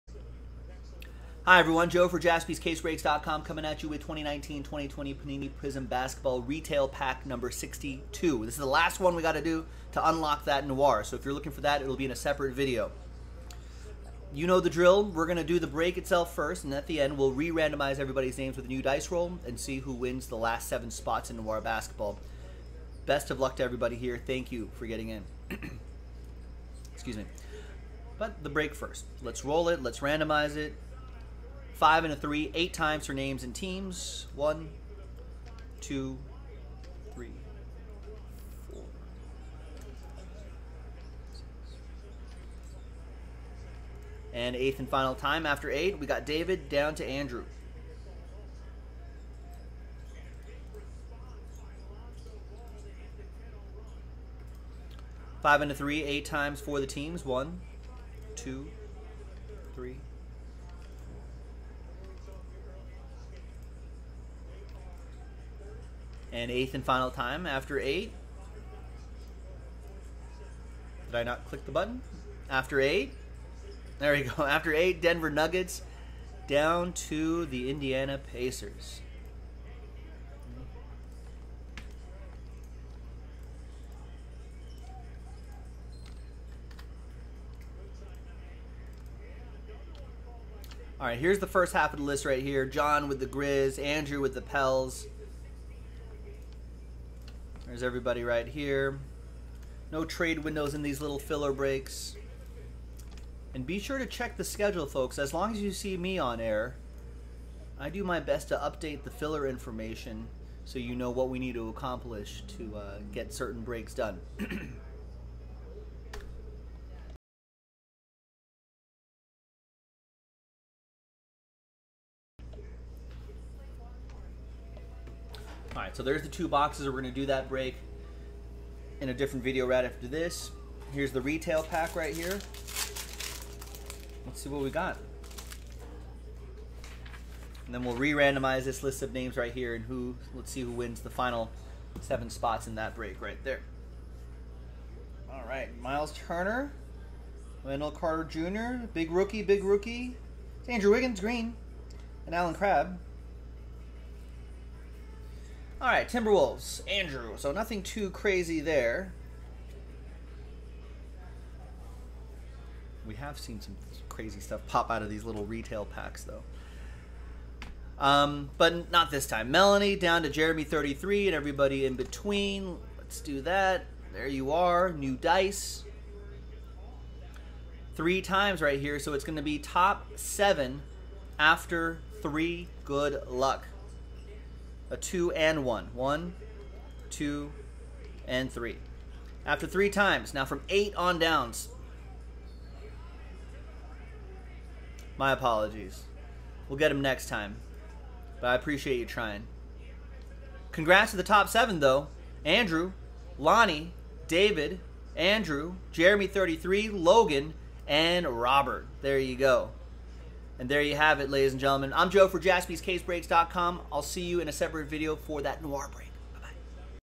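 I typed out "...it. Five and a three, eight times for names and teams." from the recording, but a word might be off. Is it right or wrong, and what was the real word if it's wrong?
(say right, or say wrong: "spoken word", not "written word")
right.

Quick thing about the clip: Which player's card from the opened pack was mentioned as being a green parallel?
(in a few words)
Andrew Wiggins.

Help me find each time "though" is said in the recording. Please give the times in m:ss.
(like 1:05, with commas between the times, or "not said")
2:46, 3:21.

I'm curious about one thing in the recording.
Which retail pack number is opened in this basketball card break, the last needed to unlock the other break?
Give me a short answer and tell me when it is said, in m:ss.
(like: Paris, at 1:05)
62, at 0:07.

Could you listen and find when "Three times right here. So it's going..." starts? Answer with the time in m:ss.
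2:57.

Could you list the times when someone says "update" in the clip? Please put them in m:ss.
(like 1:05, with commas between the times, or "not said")
1:48.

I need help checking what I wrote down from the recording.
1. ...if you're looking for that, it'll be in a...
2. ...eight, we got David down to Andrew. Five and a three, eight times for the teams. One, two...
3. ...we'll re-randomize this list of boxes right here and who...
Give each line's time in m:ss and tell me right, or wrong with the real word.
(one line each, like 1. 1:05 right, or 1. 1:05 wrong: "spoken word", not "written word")
1. 0:11 right
2. 0:45 right
3. 2:17 wrong: "names", not "boxes".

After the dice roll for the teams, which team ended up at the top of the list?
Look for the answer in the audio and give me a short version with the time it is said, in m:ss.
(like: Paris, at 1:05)
Denver Nuggets, at 1:15.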